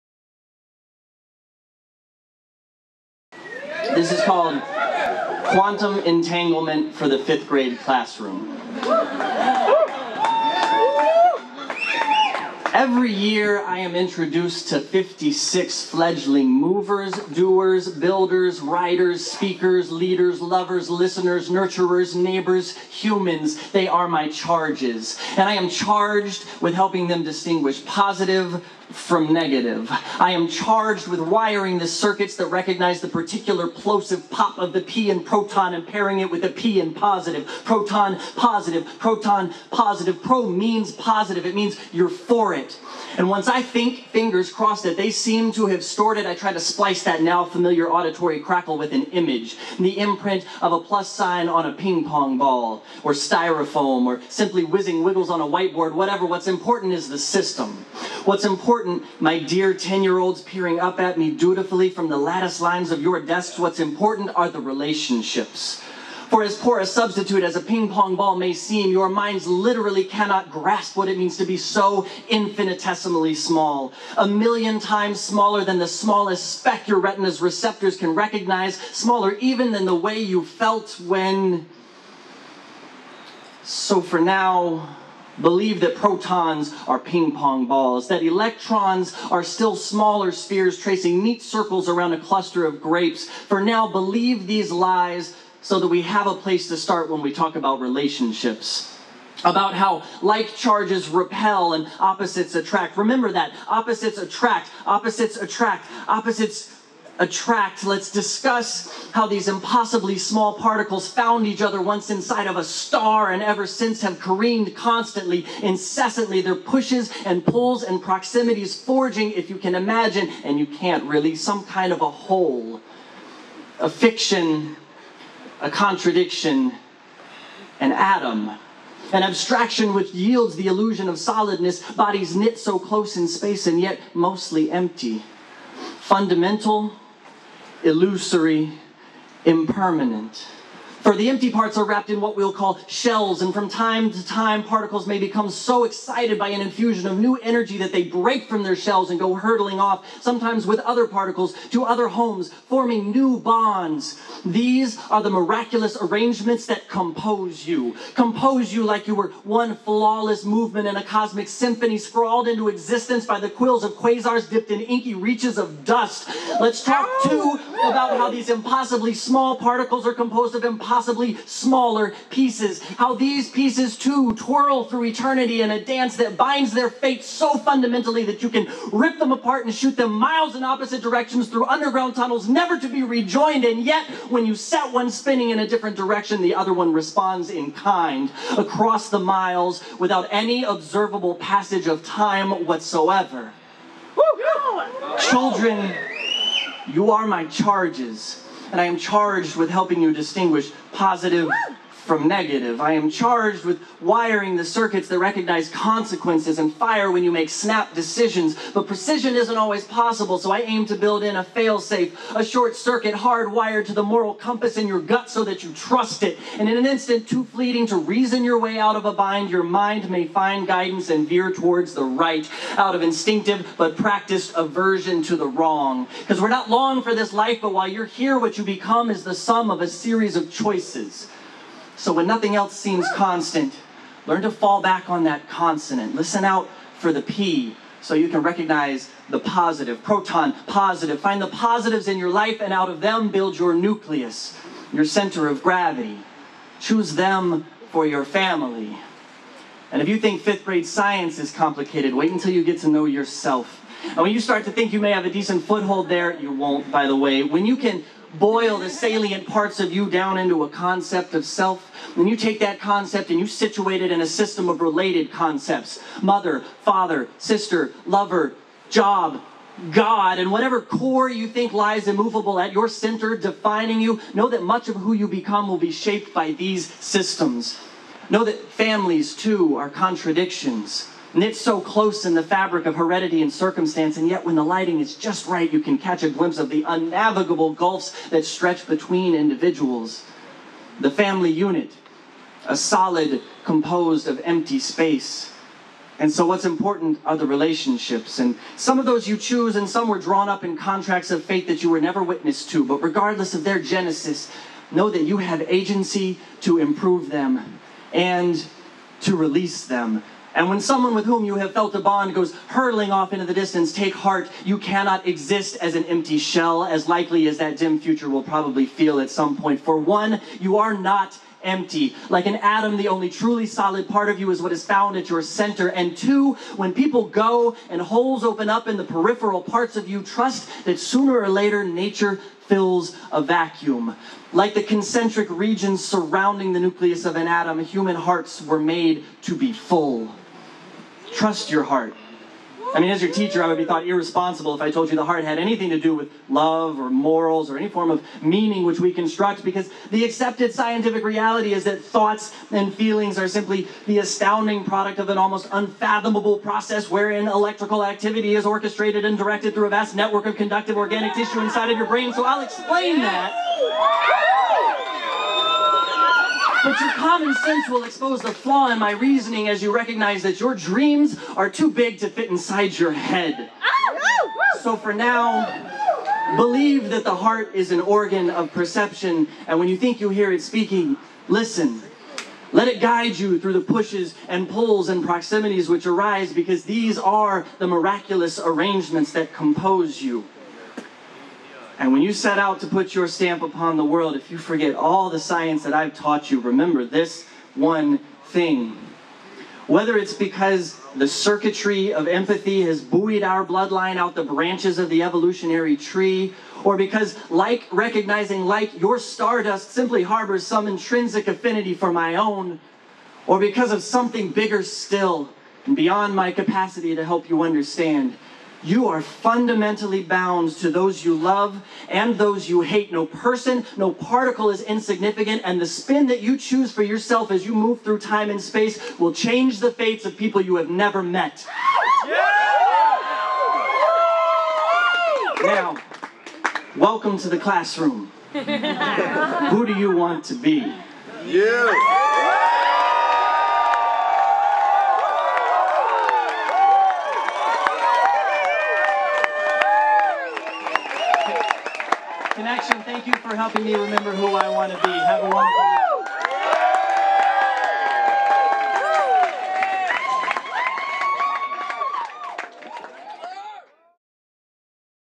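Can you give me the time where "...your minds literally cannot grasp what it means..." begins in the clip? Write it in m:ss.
1:08.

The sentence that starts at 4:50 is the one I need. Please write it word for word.
The family unit, a solid composed of empty space.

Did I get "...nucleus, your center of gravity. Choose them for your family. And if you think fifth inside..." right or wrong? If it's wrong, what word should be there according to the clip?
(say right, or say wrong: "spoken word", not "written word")
wrong: "grade", not "inside".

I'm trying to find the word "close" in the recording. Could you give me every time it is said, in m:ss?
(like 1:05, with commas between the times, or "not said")
2:12, 4:41.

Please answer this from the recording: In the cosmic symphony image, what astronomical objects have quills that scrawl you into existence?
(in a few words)
Quasars.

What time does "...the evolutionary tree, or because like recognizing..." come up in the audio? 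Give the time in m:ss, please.
6:45.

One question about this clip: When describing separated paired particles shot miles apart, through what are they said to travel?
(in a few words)
Underground tunnels.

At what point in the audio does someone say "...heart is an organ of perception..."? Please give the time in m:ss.
6:17.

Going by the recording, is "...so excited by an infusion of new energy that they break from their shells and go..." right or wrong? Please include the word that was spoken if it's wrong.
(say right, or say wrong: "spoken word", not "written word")
right.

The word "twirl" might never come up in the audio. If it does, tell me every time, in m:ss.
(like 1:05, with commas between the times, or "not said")
2:54.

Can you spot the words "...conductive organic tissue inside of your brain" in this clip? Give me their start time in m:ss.
6:00.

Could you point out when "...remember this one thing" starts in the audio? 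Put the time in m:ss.
6:36.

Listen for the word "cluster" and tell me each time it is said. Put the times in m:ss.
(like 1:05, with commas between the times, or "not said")
1:32.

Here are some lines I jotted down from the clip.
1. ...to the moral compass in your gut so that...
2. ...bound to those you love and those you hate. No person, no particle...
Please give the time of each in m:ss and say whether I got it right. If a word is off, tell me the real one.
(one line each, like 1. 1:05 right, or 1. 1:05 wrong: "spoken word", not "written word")
1. 3:33 right
2. 7:00 right.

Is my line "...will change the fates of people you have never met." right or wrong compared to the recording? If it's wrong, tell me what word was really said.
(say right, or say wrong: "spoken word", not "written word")
right.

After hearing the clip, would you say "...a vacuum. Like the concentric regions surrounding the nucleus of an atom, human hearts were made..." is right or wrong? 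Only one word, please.
right.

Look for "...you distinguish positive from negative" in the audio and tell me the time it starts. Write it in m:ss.
3:20.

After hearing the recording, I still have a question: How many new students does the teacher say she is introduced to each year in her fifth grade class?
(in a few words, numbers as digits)
56.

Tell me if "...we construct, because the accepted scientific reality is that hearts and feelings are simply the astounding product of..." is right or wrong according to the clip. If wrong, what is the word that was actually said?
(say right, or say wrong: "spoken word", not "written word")
wrong: "thoughts", not "hearts".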